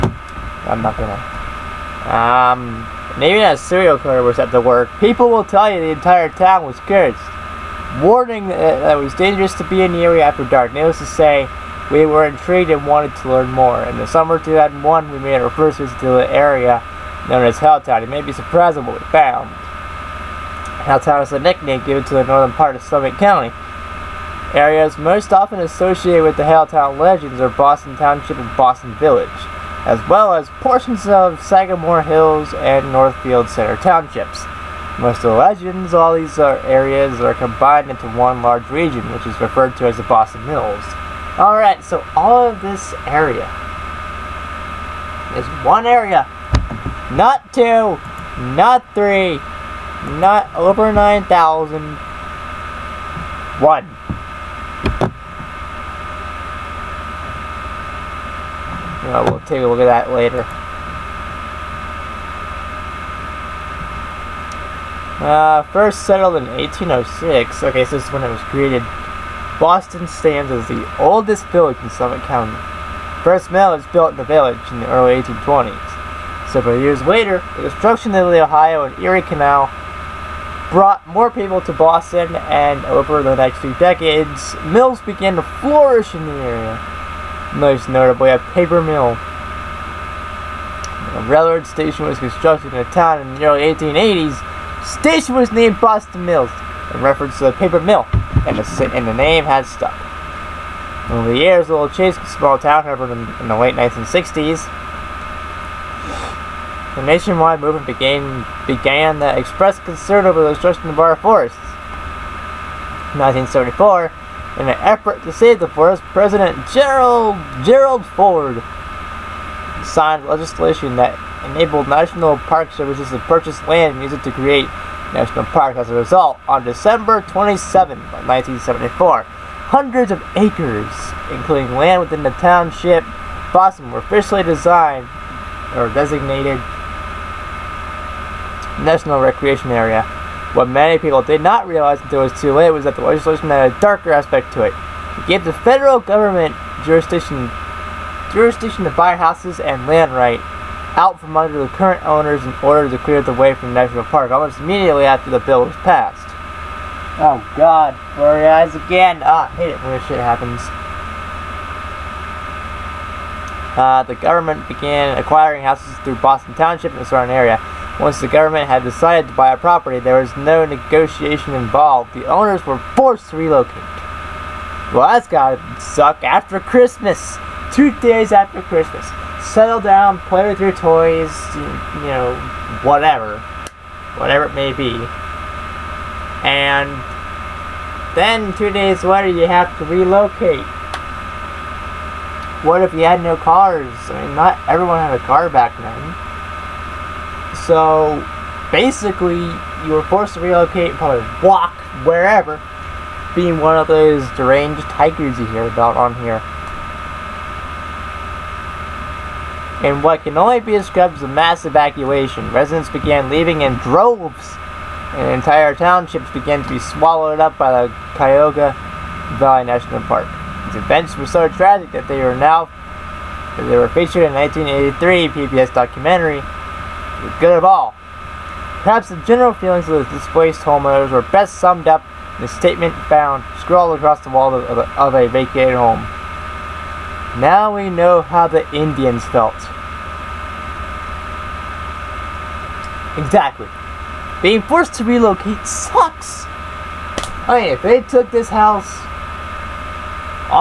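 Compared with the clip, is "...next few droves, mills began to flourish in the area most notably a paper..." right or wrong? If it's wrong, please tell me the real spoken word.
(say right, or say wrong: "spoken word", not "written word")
wrong: "decades", not "droves".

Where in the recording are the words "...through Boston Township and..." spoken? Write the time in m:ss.
2:46.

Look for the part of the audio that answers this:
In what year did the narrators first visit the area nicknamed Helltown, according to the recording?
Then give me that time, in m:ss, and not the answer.
0:14.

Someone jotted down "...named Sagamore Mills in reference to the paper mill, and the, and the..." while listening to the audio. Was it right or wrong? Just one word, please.
wrong.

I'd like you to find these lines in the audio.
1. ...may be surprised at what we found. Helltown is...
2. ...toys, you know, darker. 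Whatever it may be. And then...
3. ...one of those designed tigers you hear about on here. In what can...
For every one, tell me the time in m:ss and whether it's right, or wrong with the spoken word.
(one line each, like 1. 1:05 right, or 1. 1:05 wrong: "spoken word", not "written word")
1. 0:18 right
2. 3:00 wrong: "whatever", not "darker"
3. 3:23 wrong: "deranged", not "designed".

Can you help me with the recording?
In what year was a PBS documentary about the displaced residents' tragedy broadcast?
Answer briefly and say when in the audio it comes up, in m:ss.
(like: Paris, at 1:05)
1983, at 3:44.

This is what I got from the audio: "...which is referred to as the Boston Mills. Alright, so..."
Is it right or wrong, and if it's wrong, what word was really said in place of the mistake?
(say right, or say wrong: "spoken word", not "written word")
right.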